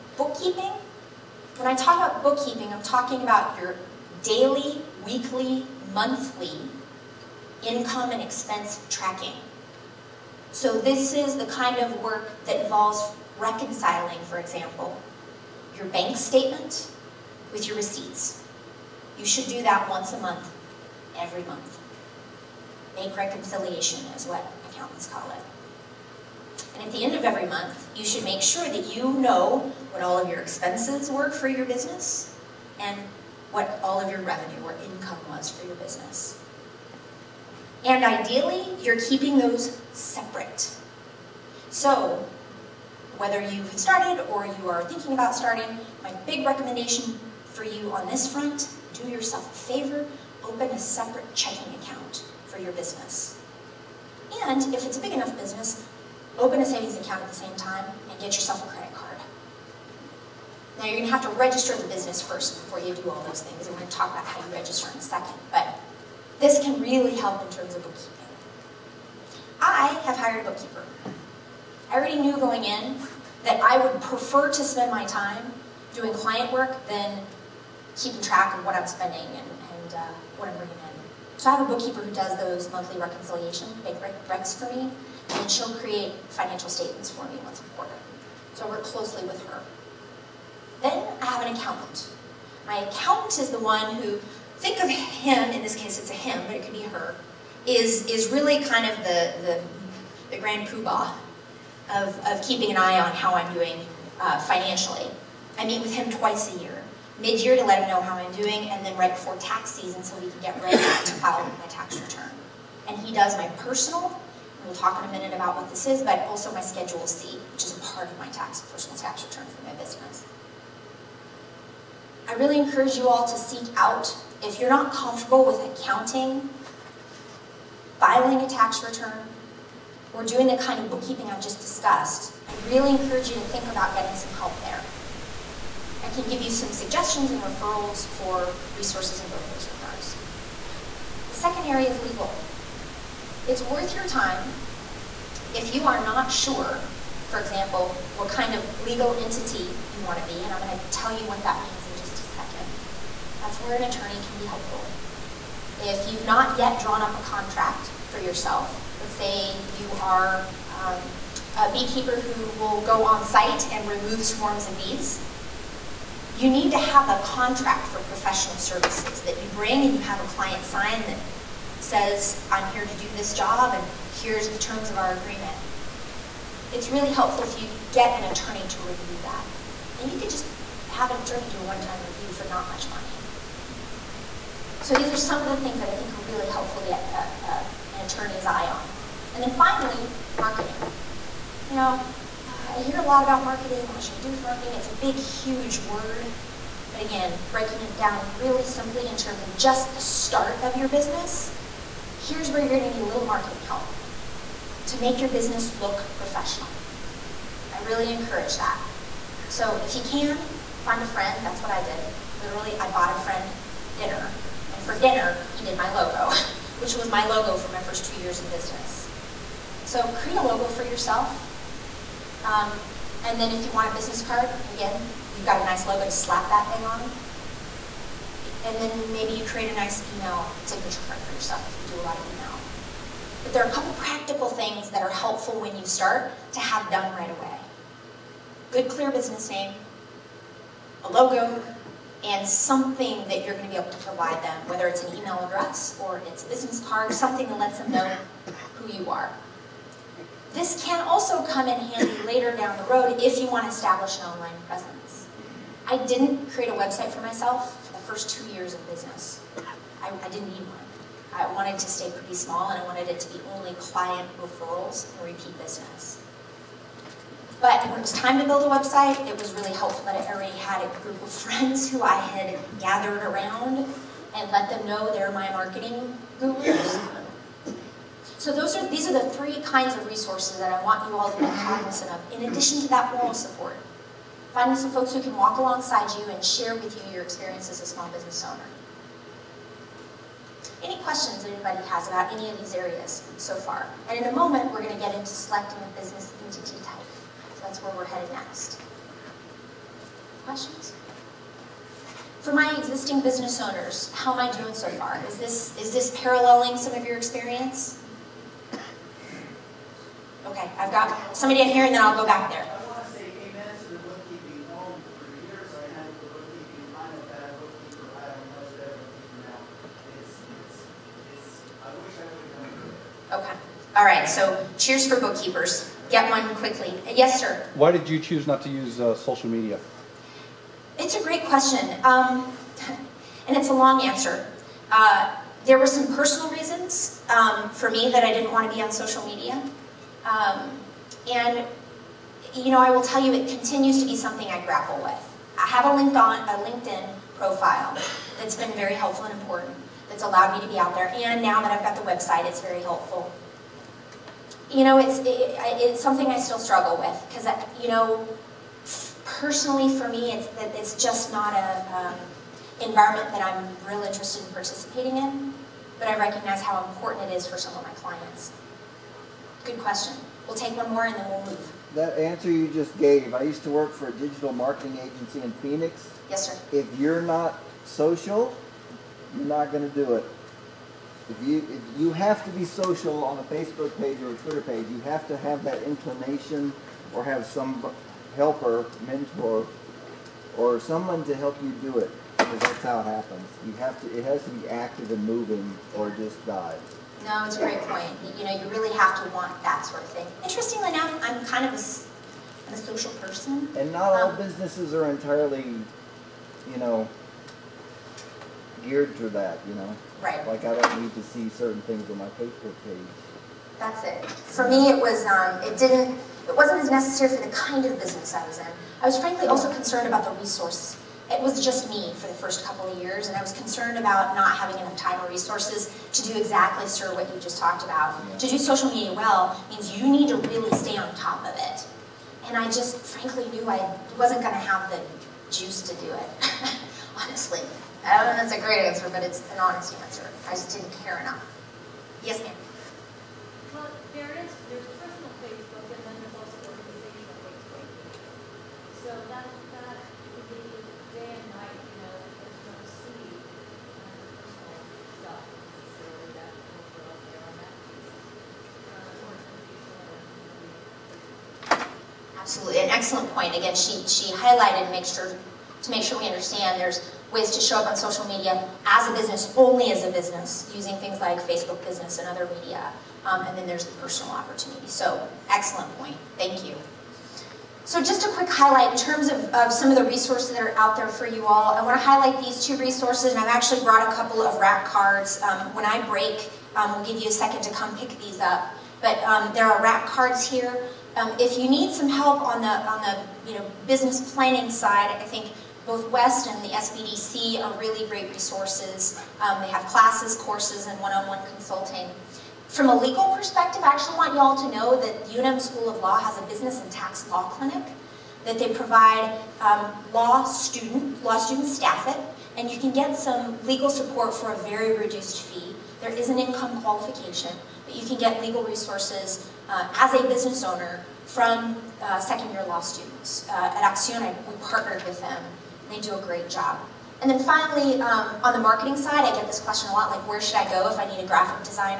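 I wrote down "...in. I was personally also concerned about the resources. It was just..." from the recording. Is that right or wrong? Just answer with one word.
wrong.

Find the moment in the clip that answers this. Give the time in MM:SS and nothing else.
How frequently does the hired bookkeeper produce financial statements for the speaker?
01:27.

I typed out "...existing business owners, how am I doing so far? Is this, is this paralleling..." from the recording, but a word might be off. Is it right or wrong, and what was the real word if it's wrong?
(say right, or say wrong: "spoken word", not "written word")
right.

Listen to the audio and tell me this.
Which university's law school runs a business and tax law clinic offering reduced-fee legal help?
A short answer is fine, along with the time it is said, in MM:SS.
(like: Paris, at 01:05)
UNM, at 08:25.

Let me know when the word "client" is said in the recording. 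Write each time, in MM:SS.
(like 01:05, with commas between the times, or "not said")
01:16, 02:50, 04:23, 06:07.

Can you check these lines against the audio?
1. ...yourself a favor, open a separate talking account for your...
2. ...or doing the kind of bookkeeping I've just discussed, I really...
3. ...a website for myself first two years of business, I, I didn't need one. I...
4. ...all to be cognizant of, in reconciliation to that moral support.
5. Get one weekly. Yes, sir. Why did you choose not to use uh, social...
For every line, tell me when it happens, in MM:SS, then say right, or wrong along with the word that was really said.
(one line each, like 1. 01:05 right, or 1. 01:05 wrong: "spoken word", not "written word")
1. 00:49 wrong: "checking", not "talking"
2. 02:10 right
3. 04:16 right
4. 04:41 wrong: "addition", not "reconciliation"
5. 05:26 wrong: "quickly", not "weekly".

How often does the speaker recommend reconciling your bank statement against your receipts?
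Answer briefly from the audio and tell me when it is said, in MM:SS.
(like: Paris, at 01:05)
Once a month, at 00:19.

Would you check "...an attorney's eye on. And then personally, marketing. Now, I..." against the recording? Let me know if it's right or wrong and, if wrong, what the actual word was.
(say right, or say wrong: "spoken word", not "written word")
wrong: "finally", not "personally".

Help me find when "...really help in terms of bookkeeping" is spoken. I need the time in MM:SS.
01:06.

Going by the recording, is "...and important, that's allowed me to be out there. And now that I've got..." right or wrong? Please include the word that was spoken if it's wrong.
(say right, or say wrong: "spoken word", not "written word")
right.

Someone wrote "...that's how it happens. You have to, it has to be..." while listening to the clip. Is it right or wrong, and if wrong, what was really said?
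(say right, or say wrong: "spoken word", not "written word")
right.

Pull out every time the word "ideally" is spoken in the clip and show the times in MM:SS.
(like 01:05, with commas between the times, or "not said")
00:38.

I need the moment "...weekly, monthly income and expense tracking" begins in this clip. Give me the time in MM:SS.
00:05.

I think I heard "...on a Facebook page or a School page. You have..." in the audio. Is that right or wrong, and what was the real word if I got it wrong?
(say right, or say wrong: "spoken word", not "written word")
wrong: "Twitter", not "School".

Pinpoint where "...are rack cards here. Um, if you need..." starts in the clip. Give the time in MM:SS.
08:09.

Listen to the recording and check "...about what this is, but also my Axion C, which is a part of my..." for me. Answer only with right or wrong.
wrong.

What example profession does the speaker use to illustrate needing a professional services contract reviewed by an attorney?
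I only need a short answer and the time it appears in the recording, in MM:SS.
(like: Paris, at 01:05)
Beekeeper, at 02:41.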